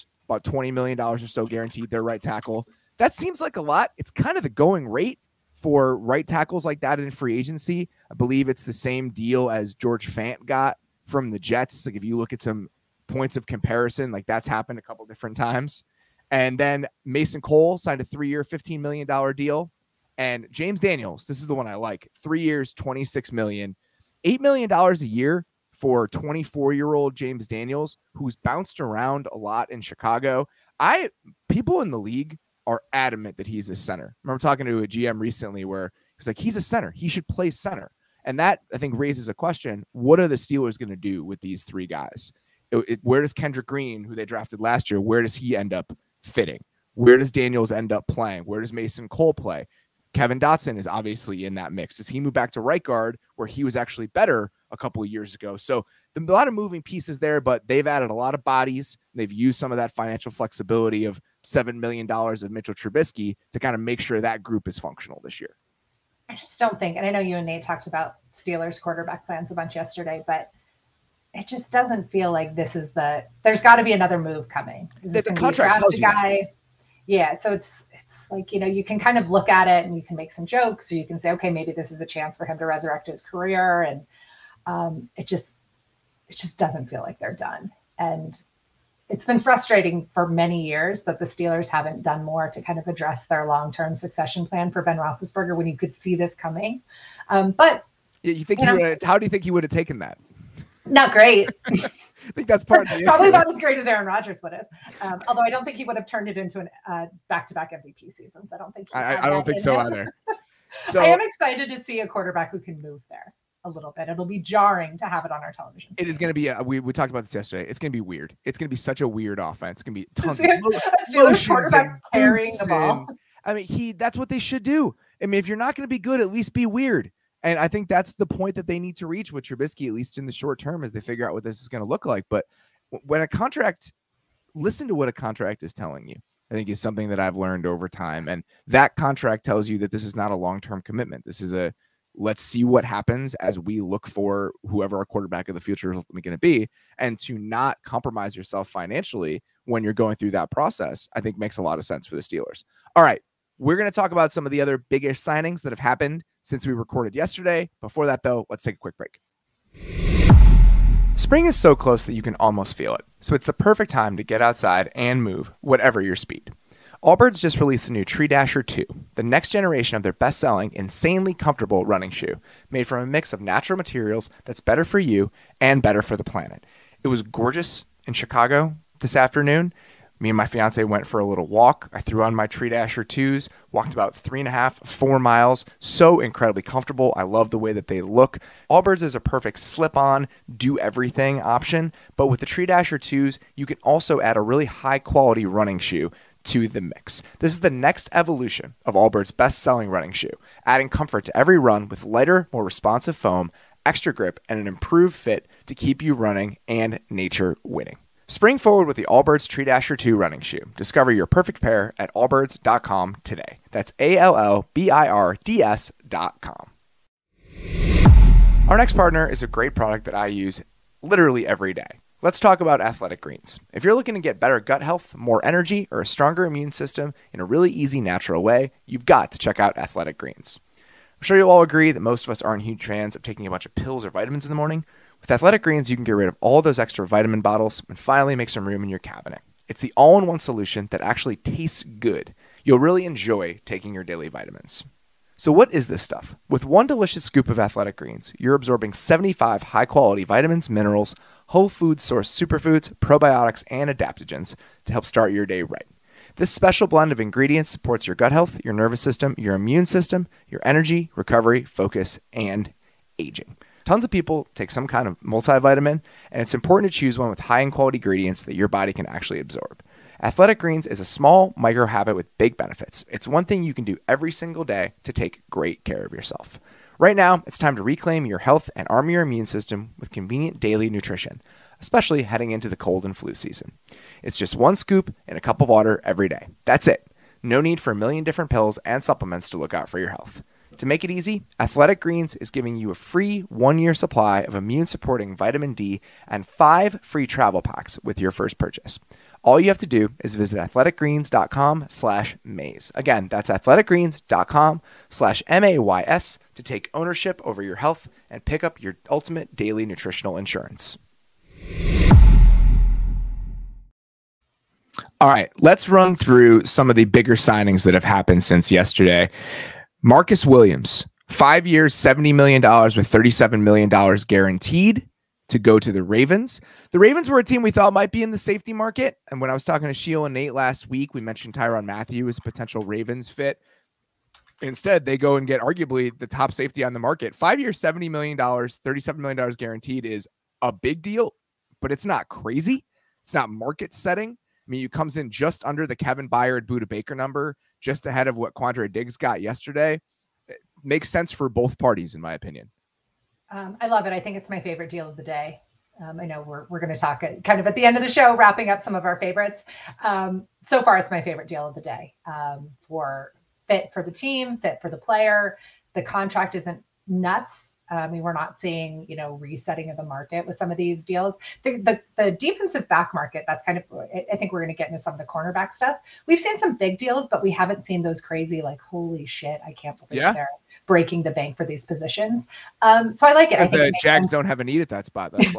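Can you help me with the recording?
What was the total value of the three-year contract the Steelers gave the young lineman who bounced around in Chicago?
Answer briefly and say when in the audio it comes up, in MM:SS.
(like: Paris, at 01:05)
$26 million, at 00:22.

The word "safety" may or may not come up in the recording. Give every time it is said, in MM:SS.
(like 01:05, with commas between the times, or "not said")
05:28, 05:36.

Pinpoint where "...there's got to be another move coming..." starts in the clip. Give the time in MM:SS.
01:13.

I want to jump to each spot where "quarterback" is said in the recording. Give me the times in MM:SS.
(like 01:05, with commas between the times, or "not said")
01:08, 01:52, 02:25.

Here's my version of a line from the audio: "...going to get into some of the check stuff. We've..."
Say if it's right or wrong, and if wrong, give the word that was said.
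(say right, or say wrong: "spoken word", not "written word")
wrong: "cornerback", not "check".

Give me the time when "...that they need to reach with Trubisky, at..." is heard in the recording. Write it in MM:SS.
02:08.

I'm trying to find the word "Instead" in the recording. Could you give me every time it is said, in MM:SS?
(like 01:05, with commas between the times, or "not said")
05:34.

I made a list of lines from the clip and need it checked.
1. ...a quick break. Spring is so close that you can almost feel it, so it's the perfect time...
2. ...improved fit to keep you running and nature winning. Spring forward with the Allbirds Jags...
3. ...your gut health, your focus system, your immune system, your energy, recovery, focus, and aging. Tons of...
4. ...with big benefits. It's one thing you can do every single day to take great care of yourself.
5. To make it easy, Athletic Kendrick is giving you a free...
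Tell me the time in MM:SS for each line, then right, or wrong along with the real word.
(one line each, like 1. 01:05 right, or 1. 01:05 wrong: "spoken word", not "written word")
1. 02:38 right
2. 03:24 wrong: "Tree", not "Jags"
3. 04:18 wrong: "nervous", not "focus"
4. 04:32 right
5. 04:50 wrong: "Greens", not "Kendrick".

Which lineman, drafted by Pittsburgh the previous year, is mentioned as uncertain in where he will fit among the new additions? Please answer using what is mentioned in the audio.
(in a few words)
Kendrick Green.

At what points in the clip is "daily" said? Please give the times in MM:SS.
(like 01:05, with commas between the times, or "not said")
04:04, 04:40, 05:09.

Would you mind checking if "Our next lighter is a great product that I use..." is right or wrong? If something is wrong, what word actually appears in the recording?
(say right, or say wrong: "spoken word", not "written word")
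wrong: "partner", not "lighter".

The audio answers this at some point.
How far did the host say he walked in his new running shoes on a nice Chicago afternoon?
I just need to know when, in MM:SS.
03:04.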